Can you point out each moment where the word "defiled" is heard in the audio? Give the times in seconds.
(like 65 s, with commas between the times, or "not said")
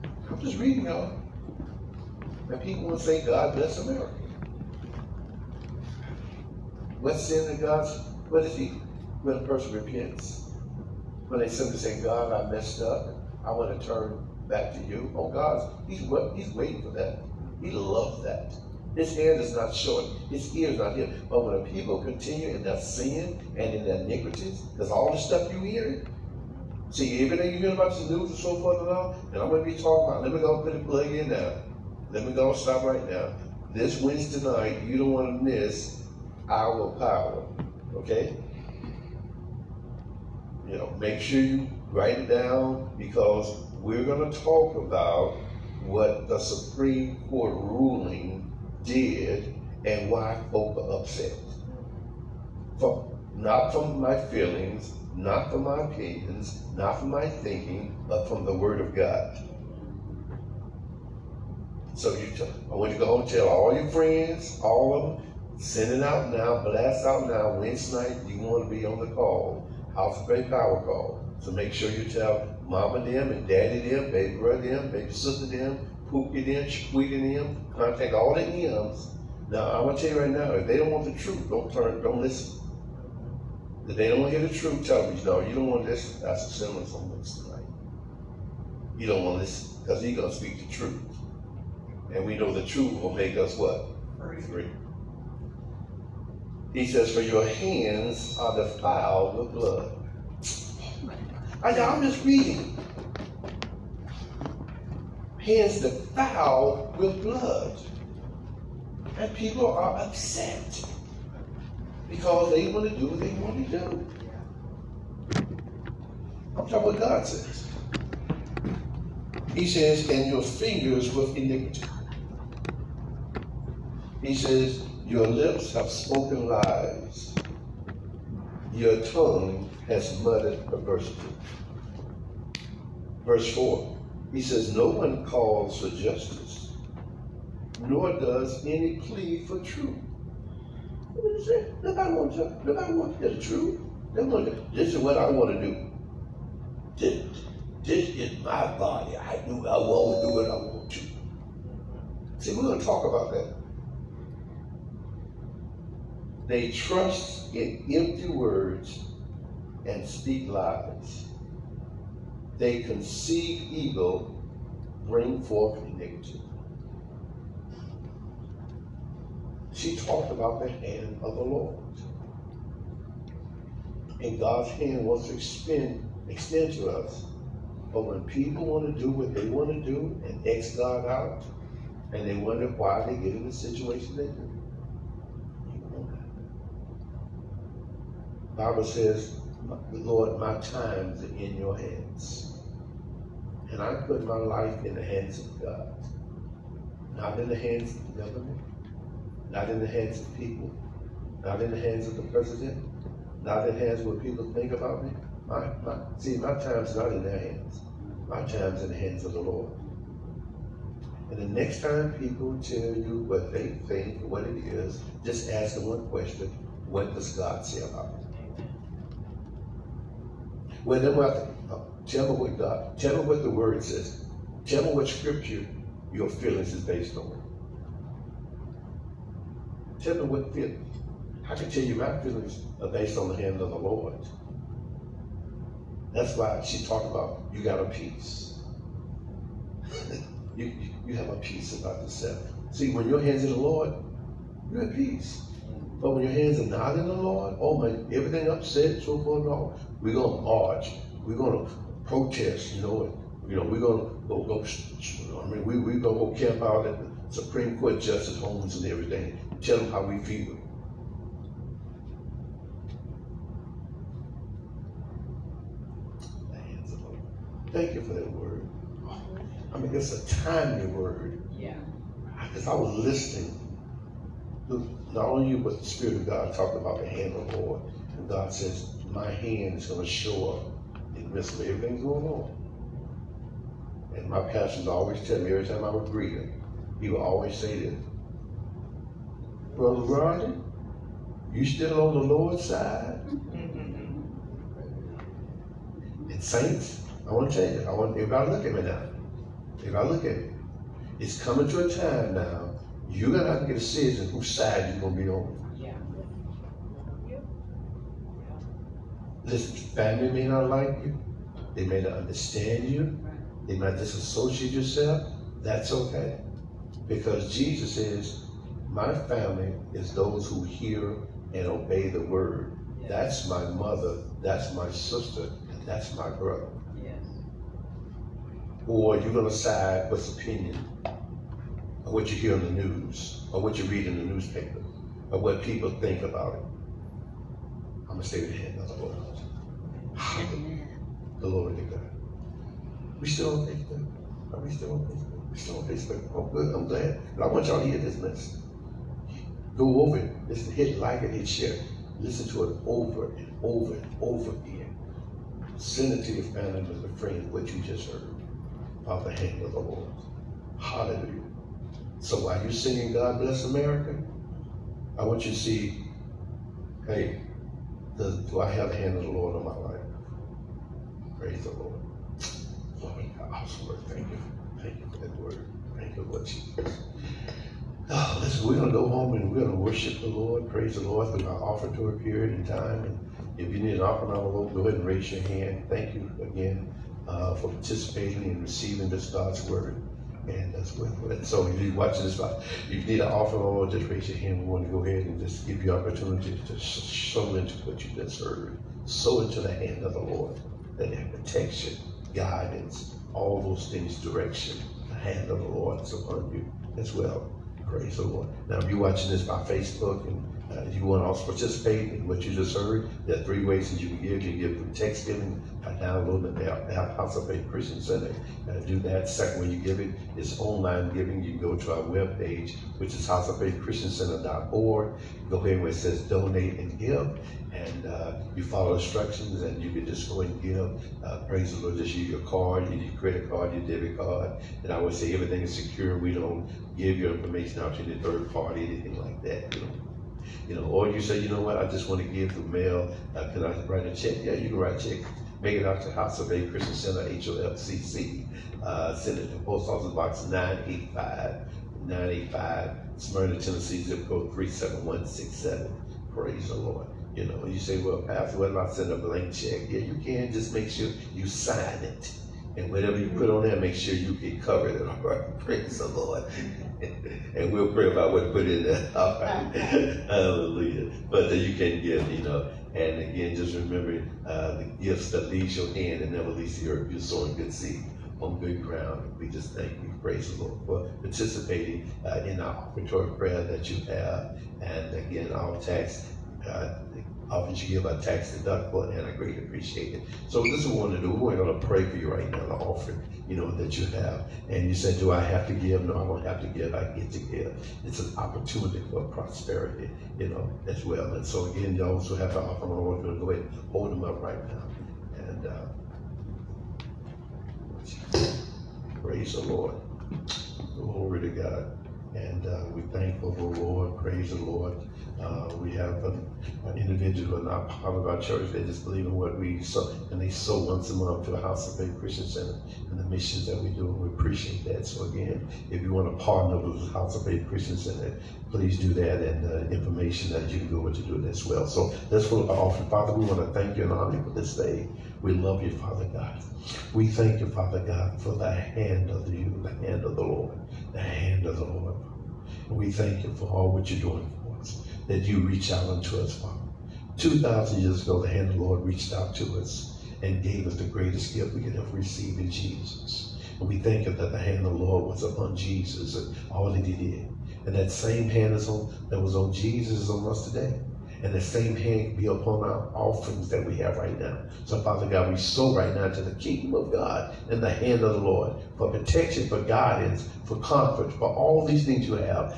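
98 s, 105 s.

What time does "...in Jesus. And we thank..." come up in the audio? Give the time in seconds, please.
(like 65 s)
552 s.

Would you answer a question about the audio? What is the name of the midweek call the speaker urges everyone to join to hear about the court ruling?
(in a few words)
House of Faith Power Call.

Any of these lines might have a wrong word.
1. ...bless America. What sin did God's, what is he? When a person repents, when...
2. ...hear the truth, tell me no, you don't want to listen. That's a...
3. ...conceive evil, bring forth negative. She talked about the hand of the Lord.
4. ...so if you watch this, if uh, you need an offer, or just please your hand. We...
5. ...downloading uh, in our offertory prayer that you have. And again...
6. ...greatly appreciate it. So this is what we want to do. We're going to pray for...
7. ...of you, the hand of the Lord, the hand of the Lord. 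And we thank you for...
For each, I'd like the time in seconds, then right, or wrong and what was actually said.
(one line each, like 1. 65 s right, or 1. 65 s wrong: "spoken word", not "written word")
1. 3 s right
2. 84 s right
3. 162 s right
4. 391 s wrong: "raise", not "please"
5. 481 s wrong: "participating", not "downloading"
6. 489 s right
7. 539 s right.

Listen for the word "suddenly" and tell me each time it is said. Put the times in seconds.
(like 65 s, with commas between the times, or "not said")
not said.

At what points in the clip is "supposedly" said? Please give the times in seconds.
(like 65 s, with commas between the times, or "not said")
not said.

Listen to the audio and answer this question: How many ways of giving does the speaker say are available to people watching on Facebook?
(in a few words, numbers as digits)
3.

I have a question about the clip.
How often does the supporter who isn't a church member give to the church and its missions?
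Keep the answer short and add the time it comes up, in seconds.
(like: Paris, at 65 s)
Once a month, at 520 s.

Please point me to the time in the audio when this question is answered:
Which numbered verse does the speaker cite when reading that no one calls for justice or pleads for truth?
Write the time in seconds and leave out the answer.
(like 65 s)
133 s.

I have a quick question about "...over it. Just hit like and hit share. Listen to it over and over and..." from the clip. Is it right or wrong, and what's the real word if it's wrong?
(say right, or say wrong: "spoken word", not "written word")
right.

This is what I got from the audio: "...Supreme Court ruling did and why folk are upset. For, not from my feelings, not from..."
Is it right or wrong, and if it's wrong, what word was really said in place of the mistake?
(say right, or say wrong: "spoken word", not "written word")
right.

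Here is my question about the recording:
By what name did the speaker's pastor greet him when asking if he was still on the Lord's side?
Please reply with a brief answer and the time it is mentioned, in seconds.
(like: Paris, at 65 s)
Brother Ronnie, at 289 s.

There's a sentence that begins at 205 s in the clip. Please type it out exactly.
My, my, see, my time's not in their hands.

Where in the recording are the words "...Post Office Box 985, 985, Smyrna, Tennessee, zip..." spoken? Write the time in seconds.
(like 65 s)
449 s.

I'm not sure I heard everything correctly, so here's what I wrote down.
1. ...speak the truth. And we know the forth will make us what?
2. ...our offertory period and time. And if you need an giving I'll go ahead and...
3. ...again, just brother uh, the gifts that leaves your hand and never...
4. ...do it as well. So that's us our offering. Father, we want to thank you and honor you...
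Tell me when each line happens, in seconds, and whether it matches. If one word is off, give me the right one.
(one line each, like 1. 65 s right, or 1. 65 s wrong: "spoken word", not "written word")
1. 90 s wrong: "truth", not "forth"
2. 381 s wrong: "offering", not "giving"
3. 473 s wrong: "remember", not "brother"
4. 531 s right.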